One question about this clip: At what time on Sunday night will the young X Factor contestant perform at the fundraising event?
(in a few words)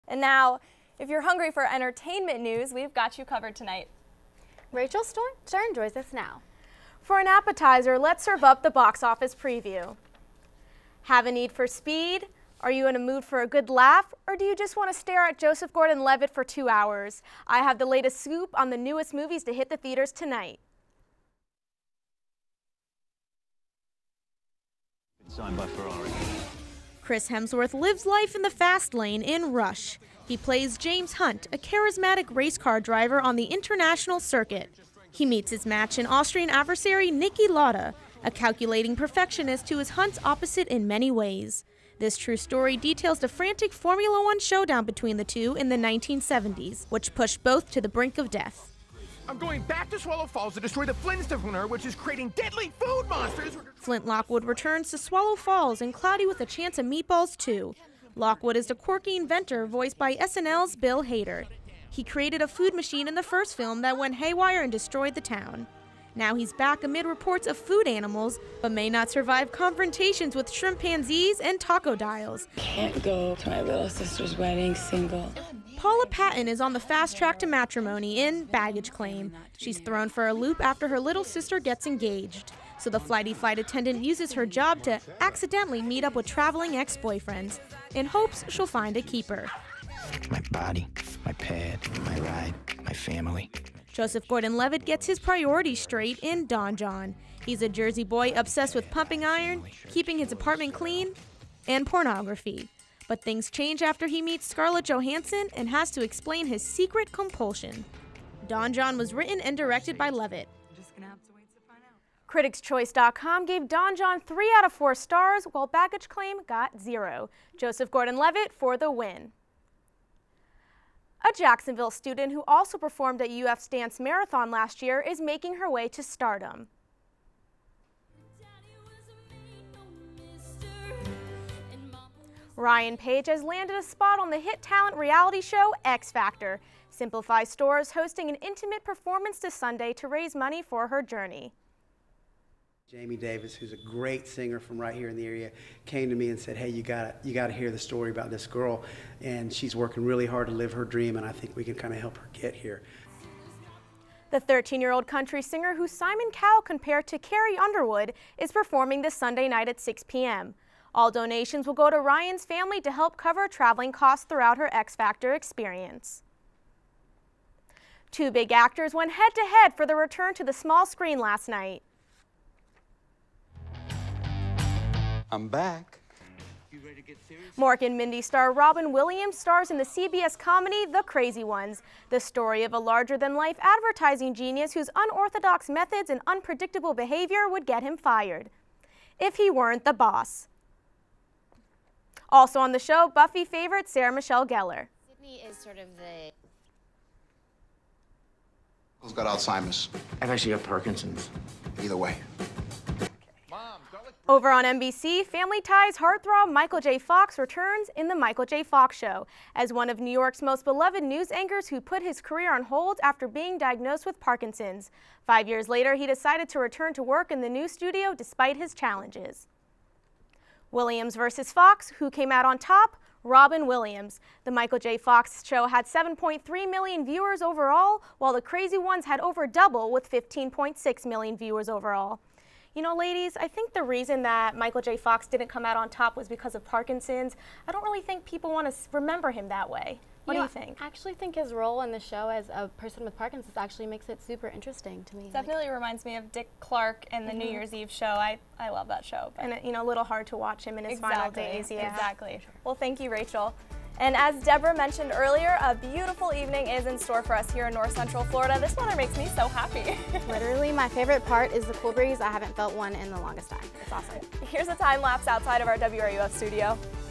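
6 p.m.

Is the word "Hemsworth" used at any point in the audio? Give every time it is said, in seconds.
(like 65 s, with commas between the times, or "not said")
27 s.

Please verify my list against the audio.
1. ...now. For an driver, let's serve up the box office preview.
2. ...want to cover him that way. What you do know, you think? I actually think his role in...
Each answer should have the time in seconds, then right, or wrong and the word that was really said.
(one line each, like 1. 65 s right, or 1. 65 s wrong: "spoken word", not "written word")
1. 6 s wrong: "appetizer", not "driver"
2. 238 s wrong: "remember", not "cover".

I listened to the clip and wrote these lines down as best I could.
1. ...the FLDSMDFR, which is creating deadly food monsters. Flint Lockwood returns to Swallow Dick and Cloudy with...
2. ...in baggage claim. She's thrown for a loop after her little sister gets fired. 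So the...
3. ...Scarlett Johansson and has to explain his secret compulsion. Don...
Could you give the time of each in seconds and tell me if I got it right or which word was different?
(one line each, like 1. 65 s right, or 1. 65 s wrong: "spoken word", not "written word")
1. 50 s wrong: "Falls", not "Dick"
2. 78 s wrong: "engaged", not "fired"
3. 104 s right.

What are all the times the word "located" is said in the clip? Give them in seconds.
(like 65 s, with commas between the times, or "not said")
not said.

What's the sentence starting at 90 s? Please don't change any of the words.
My body, my pad, my ride, my family.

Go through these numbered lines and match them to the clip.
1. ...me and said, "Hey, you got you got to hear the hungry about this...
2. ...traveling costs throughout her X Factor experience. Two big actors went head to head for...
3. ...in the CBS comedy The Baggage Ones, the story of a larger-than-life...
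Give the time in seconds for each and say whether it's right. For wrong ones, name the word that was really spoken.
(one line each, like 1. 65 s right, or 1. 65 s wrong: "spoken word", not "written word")
1. 146 s wrong: "story", not "hungry"
2. 163 s right
3. 179 s wrong: "Crazy", not "Baggage".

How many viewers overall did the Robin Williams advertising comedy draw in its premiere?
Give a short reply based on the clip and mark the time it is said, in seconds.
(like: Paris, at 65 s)
15.6 million, at 230 s.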